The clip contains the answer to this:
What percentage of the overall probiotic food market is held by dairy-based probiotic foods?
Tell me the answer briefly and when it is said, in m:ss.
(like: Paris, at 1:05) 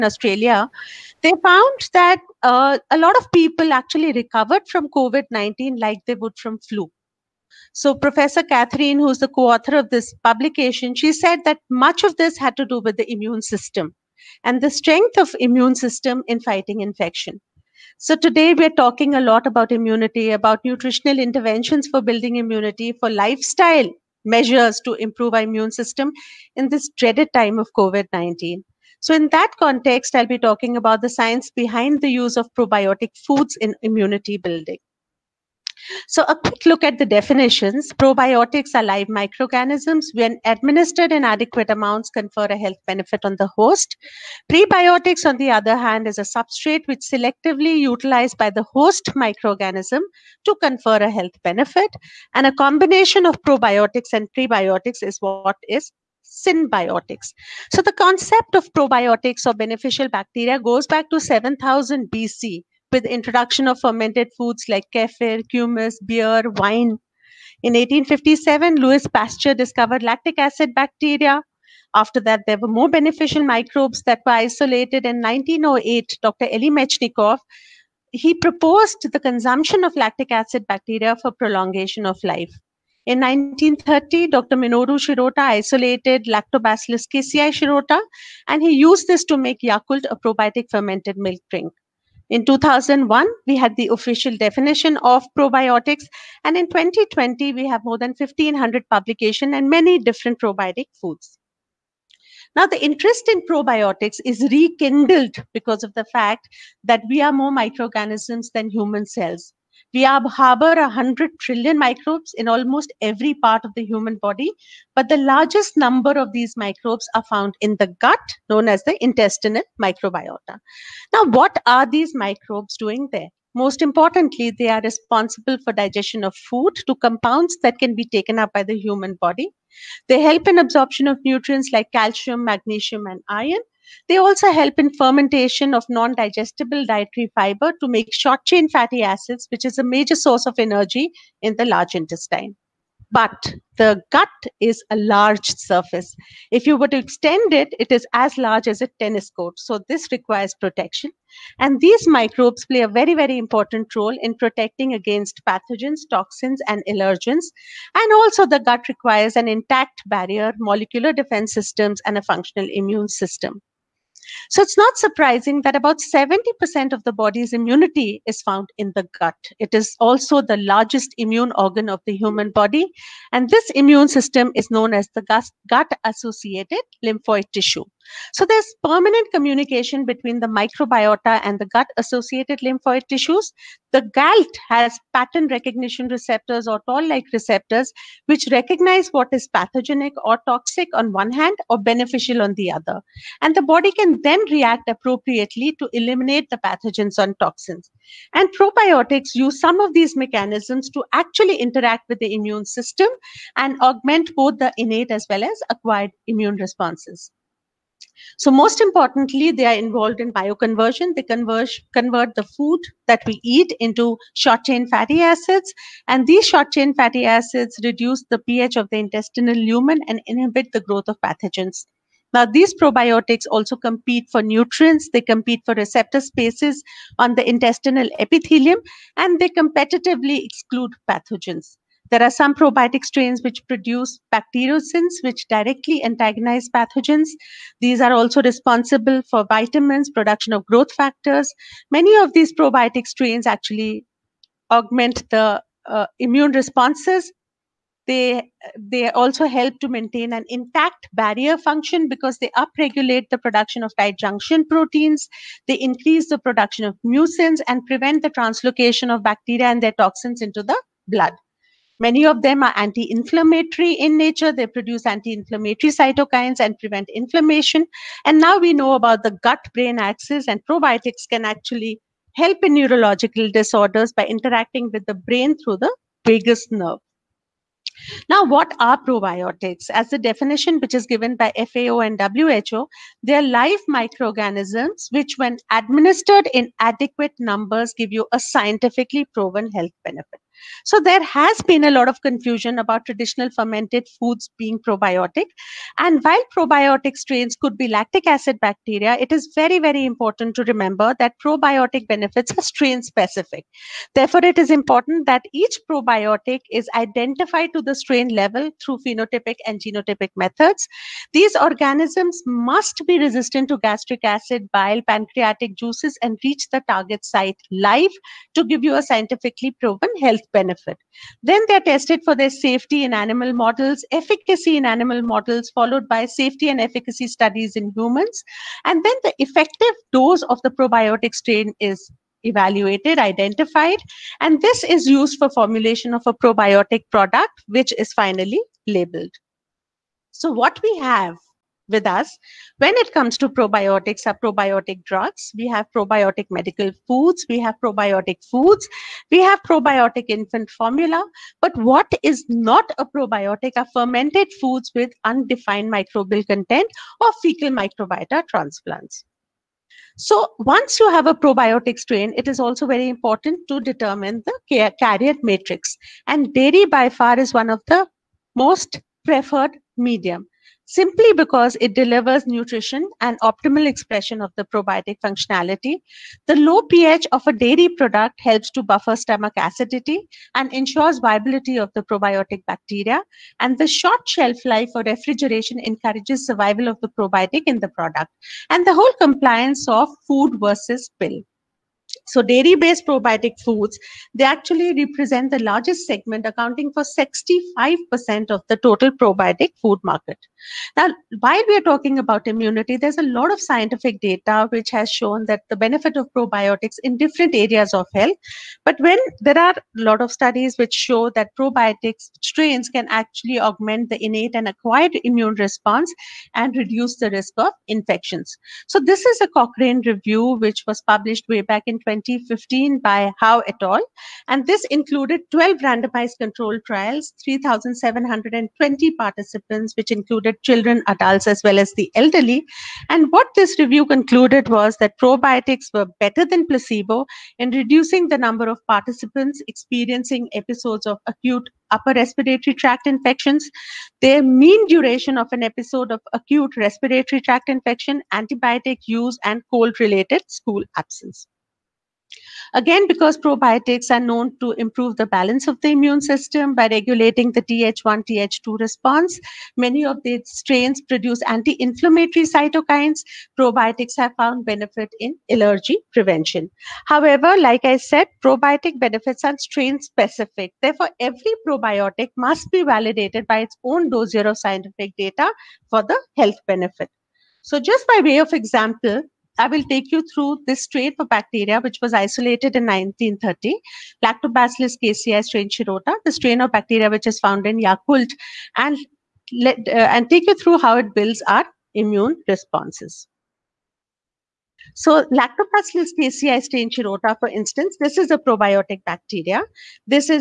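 65%, at 6:37.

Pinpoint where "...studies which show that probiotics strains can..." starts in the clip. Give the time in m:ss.
6:50.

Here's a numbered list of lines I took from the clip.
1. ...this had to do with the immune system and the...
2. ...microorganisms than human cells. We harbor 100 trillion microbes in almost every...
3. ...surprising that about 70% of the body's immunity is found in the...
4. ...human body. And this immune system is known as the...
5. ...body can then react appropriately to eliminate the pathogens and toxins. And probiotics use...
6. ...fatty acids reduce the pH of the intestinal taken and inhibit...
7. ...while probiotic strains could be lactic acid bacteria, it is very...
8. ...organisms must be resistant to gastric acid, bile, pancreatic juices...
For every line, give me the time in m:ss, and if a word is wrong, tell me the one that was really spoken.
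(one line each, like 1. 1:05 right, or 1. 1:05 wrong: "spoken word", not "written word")
1. 0:12 right
2. 1:47 right
3. 2:44 right
4. 2:52 right
5. 3:13 right
6. 3:36 wrong: "lumen", not "taken"
7. 4:56 right
8. 5:11 right.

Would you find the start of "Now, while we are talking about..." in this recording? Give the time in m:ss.
6:40.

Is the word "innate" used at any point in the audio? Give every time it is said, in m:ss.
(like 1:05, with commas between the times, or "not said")
3:24, 6:54.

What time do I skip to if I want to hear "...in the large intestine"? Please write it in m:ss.
2:21.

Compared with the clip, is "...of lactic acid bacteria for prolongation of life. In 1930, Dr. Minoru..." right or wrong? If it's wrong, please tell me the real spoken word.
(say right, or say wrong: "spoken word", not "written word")
right.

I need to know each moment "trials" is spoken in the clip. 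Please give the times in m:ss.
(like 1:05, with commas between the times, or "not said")
7:06.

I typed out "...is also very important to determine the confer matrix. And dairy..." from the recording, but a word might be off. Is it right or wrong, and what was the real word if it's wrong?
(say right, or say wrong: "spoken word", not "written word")
wrong: "carrier", not "confer".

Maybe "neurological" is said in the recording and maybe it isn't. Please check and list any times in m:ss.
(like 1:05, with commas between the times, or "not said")
4:32.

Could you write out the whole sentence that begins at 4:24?
They produce anti inflammatory cytokines and prevent inflammation.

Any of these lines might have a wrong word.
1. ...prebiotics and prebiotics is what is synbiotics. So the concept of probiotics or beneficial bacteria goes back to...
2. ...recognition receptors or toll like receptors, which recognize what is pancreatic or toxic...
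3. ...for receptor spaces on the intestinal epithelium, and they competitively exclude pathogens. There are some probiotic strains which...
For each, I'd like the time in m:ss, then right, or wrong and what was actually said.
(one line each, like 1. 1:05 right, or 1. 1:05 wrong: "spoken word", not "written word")
1. 0:53 wrong: "probiotics", not "prebiotics"
2. 3:05 wrong: "pathogenic", not "pancreatic"
3. 3:45 right.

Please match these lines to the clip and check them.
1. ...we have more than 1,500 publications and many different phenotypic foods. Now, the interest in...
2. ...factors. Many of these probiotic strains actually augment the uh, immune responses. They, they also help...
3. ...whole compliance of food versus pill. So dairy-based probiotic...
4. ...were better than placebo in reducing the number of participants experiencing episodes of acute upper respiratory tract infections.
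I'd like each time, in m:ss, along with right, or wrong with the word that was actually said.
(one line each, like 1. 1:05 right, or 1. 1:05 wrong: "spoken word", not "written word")
1. 1:37 wrong: "probiotic", not "phenotypic"
2. 4:00 right
3. 6:28 right
4. 7:15 right.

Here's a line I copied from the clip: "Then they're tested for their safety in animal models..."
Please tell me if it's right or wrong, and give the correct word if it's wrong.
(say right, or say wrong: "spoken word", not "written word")
right.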